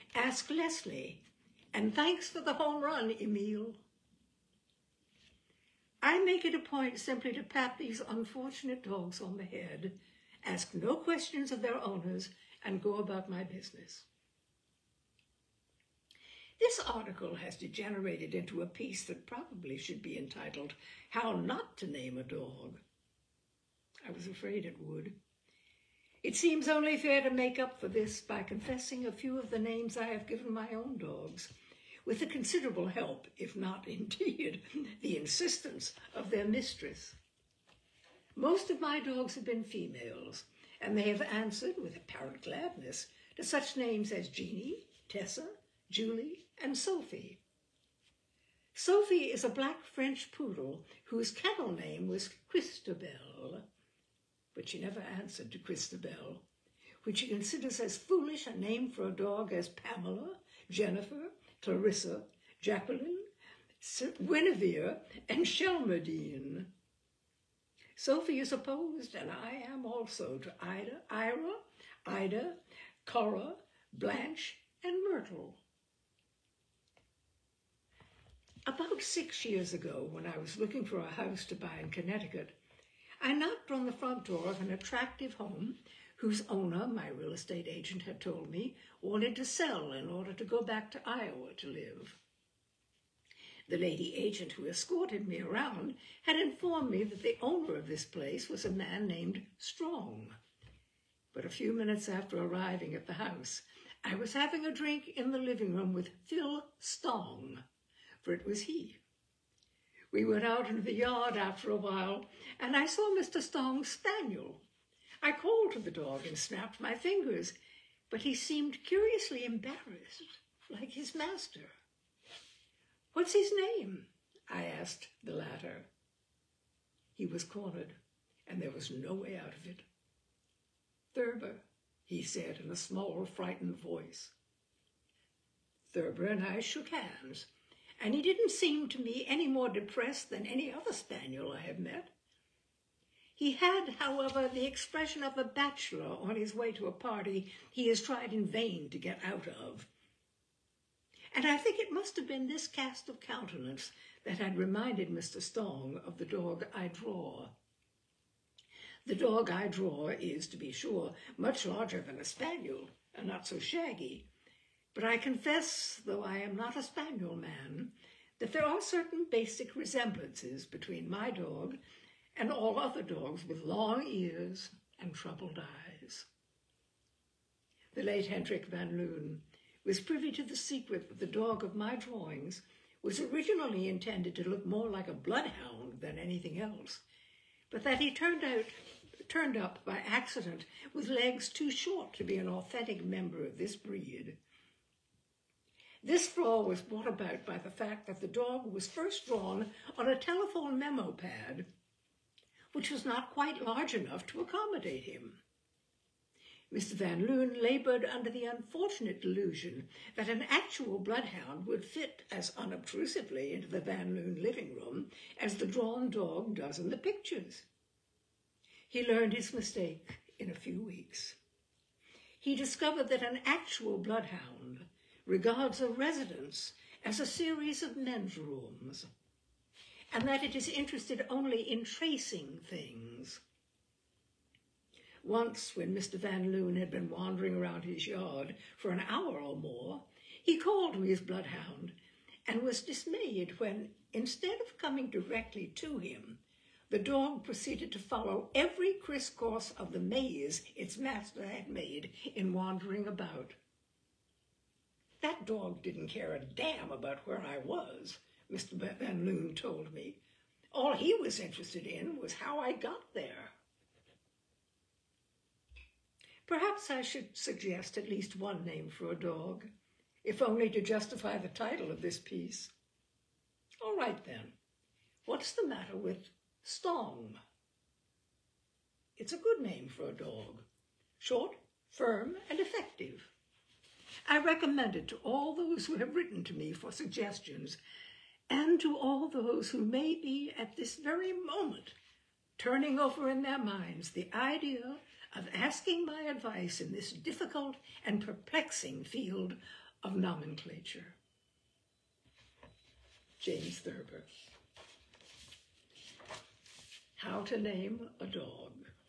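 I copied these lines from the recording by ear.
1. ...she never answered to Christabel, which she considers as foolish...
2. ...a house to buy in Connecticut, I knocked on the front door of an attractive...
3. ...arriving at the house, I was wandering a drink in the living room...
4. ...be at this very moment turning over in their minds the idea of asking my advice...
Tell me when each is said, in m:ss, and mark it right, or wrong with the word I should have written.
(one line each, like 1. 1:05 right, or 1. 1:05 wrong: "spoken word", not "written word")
1. 0:54 right
2. 1:20 right
3. 1:42 wrong: "having", not "wandering"
4. 4:50 right.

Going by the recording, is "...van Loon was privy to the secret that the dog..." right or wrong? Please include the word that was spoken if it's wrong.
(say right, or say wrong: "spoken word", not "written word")
right.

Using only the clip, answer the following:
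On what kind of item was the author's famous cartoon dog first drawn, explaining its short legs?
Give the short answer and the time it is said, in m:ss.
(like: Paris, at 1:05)
telephone memo pad, at 3:20.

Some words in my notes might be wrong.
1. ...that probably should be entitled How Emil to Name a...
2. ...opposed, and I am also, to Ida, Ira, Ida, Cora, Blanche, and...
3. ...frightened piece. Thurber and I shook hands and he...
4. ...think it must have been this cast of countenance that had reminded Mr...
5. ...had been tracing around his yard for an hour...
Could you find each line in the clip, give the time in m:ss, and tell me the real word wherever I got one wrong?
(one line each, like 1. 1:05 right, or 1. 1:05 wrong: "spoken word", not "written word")
1. 0:19 wrong: "Not", not "Emil"
2. 1:08 right
3. 2:13 wrong: "voice", not "piece"
4. 2:31 right
5. 3:56 wrong: "wandering", not "tracing".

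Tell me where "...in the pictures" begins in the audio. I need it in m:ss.
3:36.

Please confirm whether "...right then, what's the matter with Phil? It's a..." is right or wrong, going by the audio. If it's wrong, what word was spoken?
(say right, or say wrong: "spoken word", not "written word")
wrong: "Stong", not "Phil".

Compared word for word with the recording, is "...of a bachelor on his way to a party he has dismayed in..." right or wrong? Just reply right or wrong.
wrong.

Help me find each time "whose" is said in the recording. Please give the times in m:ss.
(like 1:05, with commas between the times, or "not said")
0:51, 1:26.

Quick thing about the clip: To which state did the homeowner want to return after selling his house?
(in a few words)
Iowa.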